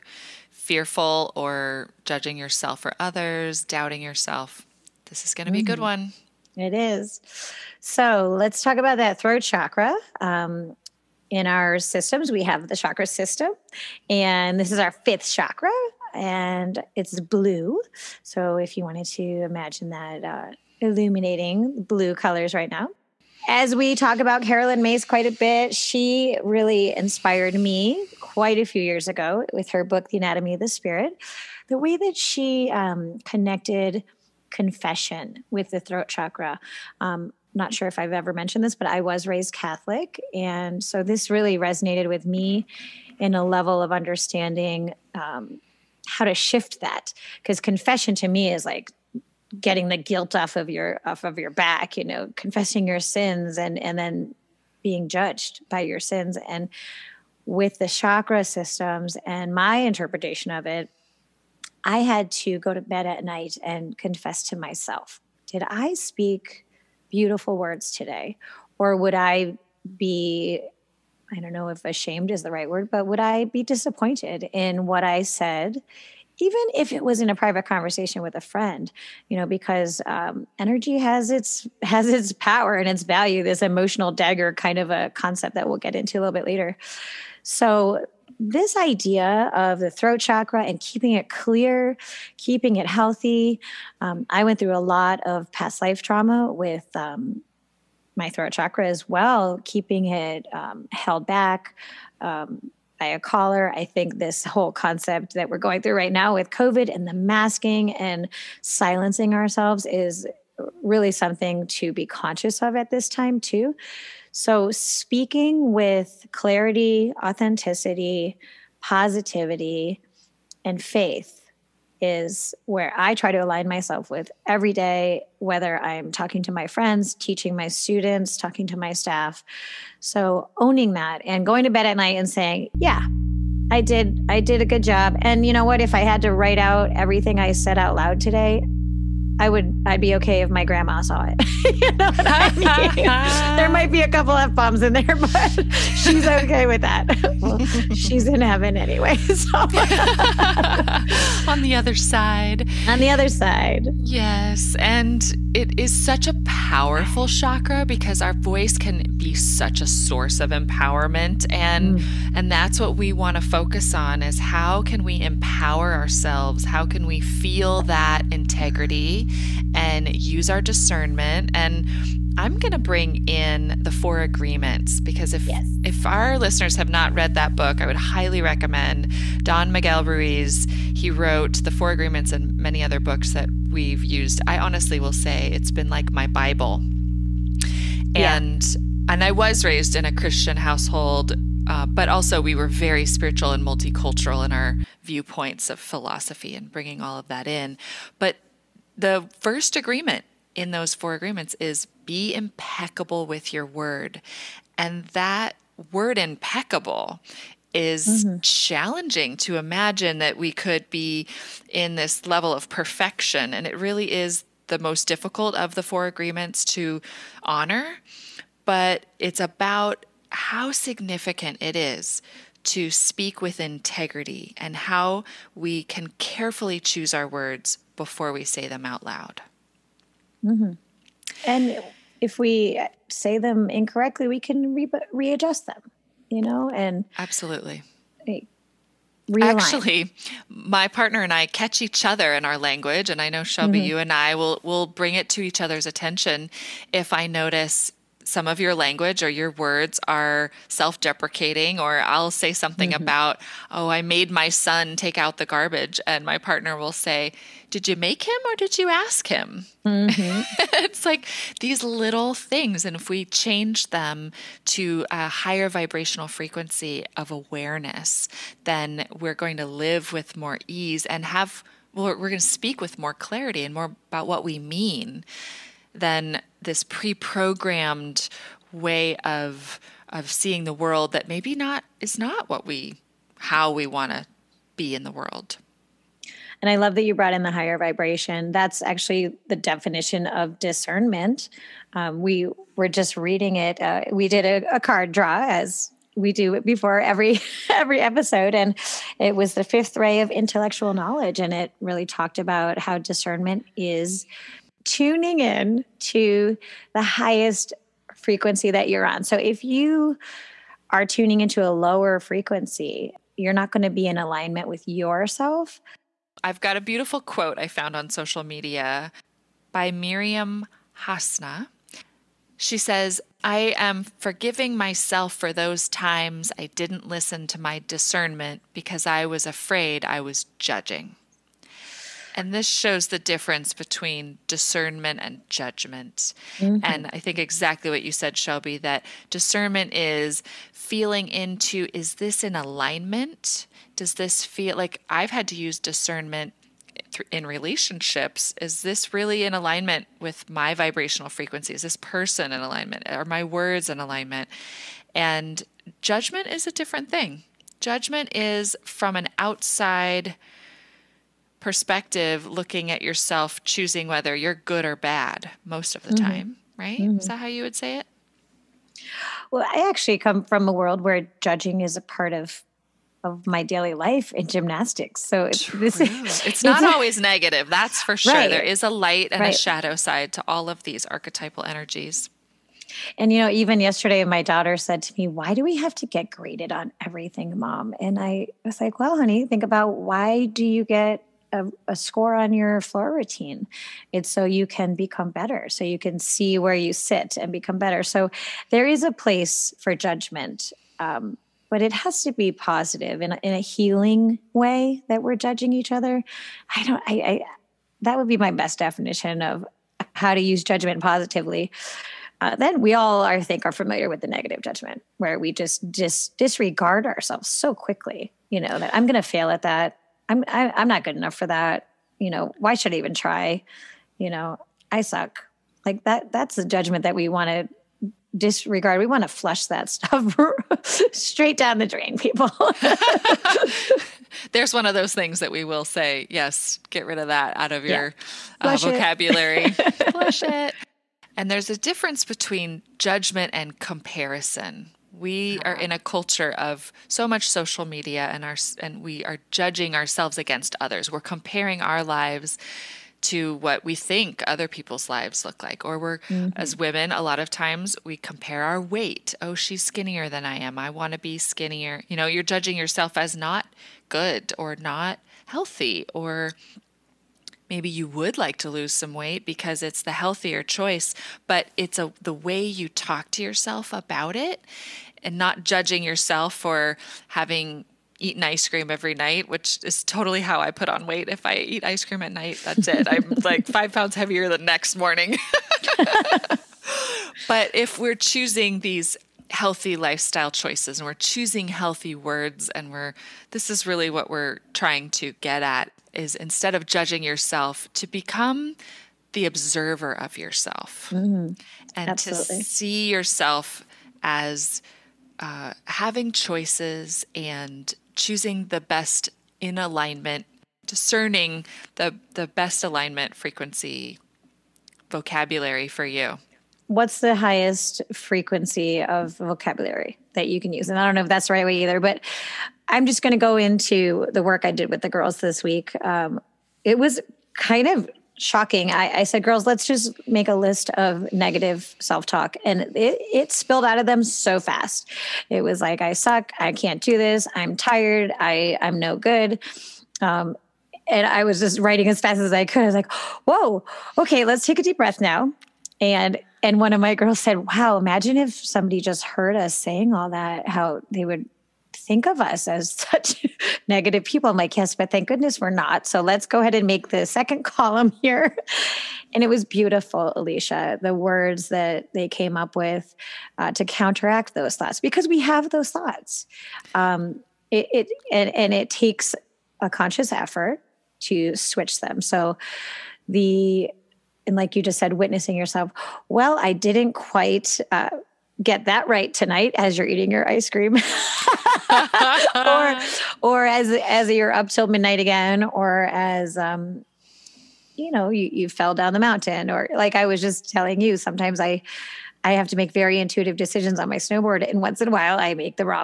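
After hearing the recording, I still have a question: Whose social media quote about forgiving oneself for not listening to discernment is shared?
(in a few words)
Maryam Hasnaa.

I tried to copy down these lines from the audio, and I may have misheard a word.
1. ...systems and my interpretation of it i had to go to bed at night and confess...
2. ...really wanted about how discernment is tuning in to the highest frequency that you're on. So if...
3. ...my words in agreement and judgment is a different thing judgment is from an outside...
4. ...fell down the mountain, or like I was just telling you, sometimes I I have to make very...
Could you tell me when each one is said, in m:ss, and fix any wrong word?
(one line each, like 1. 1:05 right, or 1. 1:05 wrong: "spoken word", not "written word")
1. 0:58 right
2. 5:01 wrong: "talked", not "wanted"
3. 5:53 wrong: "alignment", not "agreement"
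4. 9:48 right.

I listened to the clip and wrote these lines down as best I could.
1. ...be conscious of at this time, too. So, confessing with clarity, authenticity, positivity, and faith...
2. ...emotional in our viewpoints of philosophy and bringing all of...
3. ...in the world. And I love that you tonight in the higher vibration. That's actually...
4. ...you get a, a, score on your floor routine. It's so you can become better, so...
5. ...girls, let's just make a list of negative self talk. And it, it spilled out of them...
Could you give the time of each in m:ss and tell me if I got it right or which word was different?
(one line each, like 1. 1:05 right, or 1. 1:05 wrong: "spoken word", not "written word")
1. 1:51 wrong: "speaking", not "confessing"
2. 3:13 wrong: "multicultural", not "emotional"
3. 4:44 wrong: "brought", not "tonight"
4. 6:30 right
5. 8:49 right.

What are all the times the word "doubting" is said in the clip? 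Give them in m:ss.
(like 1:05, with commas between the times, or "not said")
0:03.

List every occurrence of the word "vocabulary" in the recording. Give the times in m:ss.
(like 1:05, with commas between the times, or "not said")
7:18, 8:35, 8:39.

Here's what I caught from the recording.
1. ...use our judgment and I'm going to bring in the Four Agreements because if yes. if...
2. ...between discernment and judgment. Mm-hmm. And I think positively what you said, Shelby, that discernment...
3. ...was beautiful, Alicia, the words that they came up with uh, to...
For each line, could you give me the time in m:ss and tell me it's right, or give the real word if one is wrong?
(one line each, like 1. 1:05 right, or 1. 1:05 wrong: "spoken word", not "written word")
1. 2:50 wrong: "discernment", not "judgment"
2. 5:33 wrong: "exactly", not "positively"
3. 9:19 right.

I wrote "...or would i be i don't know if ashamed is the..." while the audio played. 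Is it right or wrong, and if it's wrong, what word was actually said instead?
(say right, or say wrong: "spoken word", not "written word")
right.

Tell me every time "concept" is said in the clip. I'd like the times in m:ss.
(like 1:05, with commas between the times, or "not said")
1:25, 1:44.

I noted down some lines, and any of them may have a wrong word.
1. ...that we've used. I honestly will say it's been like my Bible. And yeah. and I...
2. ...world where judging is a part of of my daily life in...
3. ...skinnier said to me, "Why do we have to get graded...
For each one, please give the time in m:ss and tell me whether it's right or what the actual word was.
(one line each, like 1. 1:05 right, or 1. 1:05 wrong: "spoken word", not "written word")
1. 3:03 right
2. 6:10 right
3. 6:24 wrong: "daughter", not "skinnier".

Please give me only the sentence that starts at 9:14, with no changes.
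I'm like, Yes, but thank goodness we're not.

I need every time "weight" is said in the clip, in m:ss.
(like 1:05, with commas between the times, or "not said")
7:38, 7:49, 8:01.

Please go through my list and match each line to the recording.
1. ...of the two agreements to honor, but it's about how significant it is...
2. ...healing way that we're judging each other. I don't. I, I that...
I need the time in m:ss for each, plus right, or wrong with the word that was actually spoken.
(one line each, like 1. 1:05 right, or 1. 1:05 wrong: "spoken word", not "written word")
1. 3:35 wrong: "four", not "two"
2. 6:43 right.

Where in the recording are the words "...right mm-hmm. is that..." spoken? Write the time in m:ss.
6:06.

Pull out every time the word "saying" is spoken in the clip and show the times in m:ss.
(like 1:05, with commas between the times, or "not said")
2:12, 9:09.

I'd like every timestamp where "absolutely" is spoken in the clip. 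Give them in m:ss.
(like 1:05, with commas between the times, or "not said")
3:57, 8:22.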